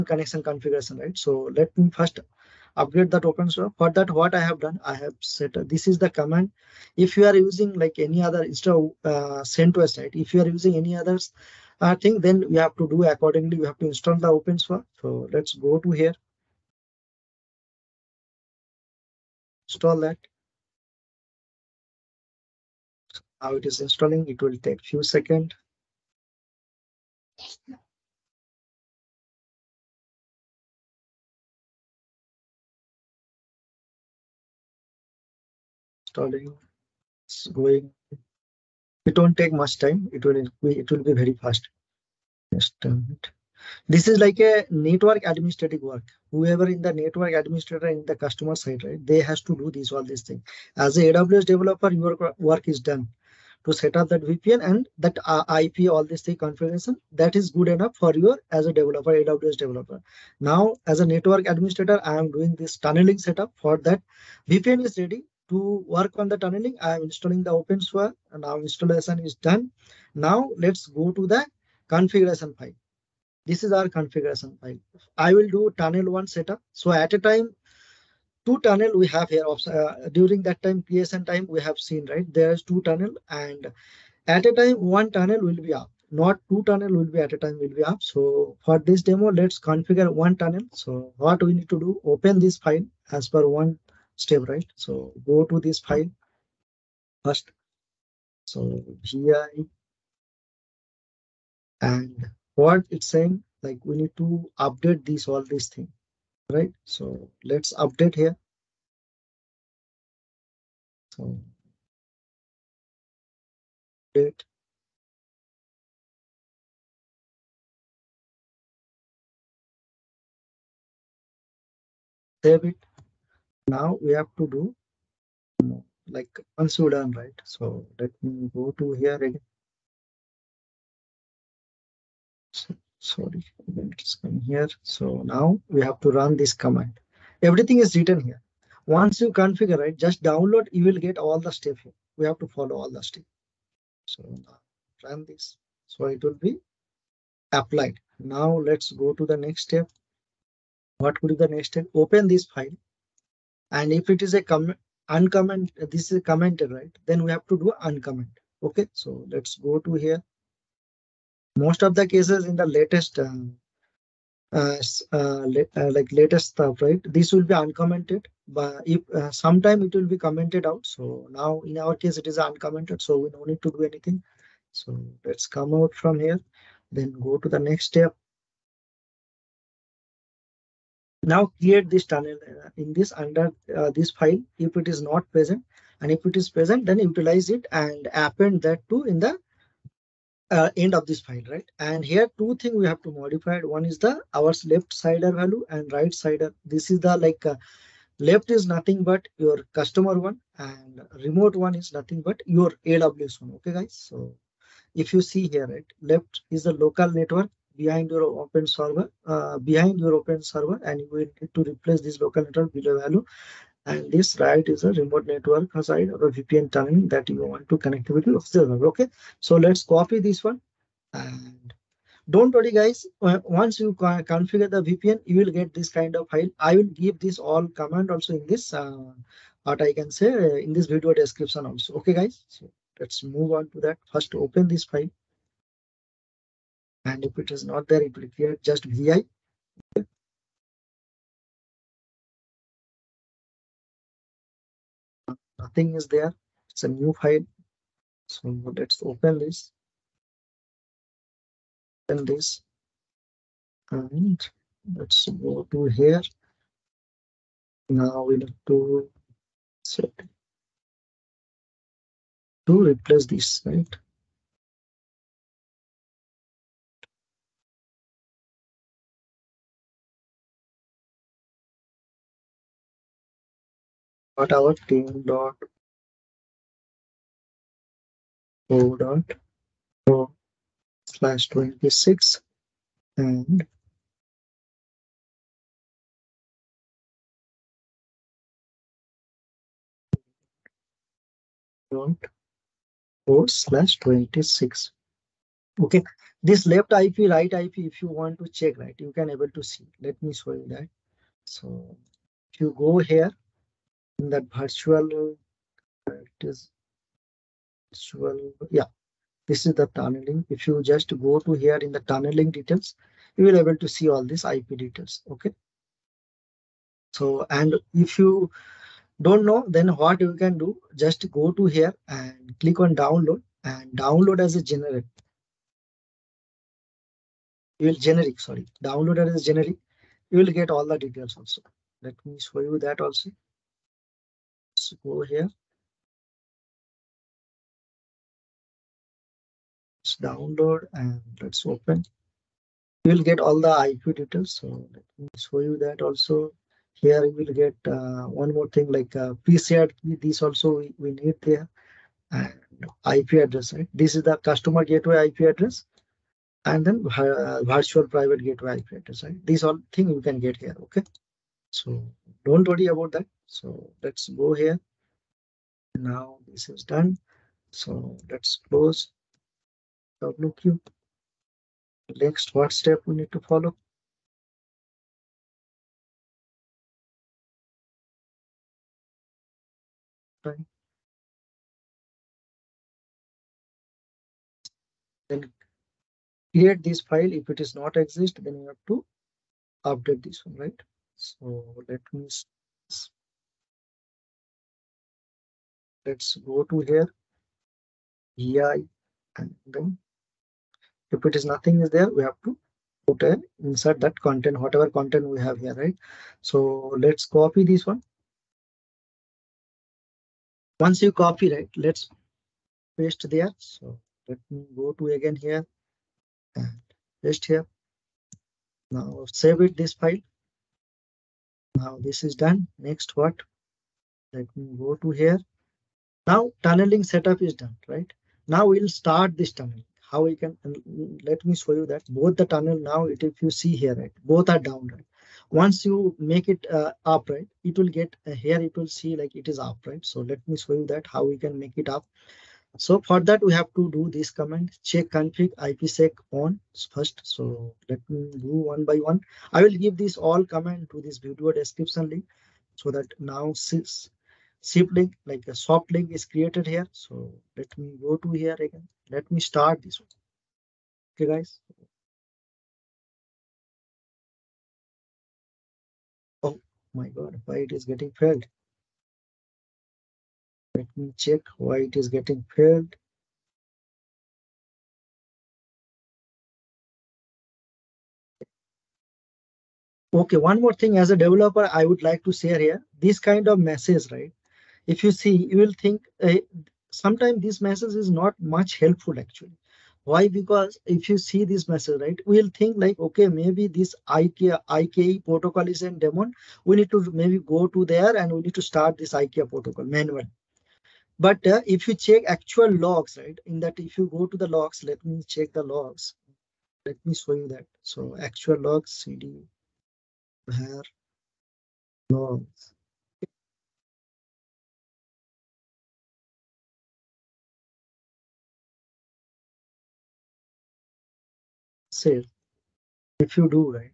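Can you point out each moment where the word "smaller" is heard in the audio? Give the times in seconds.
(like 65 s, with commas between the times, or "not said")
not said.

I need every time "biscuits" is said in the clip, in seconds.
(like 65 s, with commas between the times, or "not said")
not said.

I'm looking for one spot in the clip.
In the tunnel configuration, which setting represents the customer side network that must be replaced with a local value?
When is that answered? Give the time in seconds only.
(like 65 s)
194 s.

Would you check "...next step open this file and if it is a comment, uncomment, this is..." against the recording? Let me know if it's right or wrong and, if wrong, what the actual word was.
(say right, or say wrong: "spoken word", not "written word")
right.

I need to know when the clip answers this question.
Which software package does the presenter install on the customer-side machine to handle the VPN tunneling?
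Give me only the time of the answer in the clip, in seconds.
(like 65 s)
67 s.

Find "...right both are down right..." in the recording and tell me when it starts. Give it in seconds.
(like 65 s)
433 s.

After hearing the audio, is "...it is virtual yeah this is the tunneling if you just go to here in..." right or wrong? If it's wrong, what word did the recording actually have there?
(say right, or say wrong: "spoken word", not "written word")
right.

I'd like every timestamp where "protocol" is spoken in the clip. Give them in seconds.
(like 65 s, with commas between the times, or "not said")
495 s, 499 s.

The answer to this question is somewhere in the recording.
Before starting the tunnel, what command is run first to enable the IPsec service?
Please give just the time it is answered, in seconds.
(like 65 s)
444 s.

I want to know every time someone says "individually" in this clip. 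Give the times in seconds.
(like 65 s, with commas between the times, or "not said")
not said.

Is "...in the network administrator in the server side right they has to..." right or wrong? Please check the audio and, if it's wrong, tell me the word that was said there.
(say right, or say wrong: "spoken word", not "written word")
wrong: "customer", not "server".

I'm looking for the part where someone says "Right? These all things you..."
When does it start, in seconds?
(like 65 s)
359 s.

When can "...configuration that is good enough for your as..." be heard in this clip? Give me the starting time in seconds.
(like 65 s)
56 s.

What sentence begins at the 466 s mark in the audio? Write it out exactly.
Oh my God, why it is getting failed?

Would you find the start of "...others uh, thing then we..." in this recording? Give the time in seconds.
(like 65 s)
10 s.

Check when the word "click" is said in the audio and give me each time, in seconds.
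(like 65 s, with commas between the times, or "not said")
322 s.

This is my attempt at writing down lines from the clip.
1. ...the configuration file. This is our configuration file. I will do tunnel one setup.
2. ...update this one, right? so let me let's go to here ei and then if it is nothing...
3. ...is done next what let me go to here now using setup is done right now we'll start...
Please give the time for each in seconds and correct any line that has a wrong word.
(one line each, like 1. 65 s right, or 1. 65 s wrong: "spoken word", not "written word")
1. 71 s right
2. 389 s right
3. 422 s wrong: "tunneling", not "using".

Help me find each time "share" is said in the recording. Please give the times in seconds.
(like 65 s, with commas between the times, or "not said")
482 s.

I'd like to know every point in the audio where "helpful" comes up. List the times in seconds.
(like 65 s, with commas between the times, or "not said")
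488 s.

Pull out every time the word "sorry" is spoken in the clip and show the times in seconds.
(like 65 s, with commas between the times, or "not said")
133 s, 328 s.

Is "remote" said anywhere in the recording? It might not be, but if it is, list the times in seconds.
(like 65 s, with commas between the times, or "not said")
201 s, 214 s.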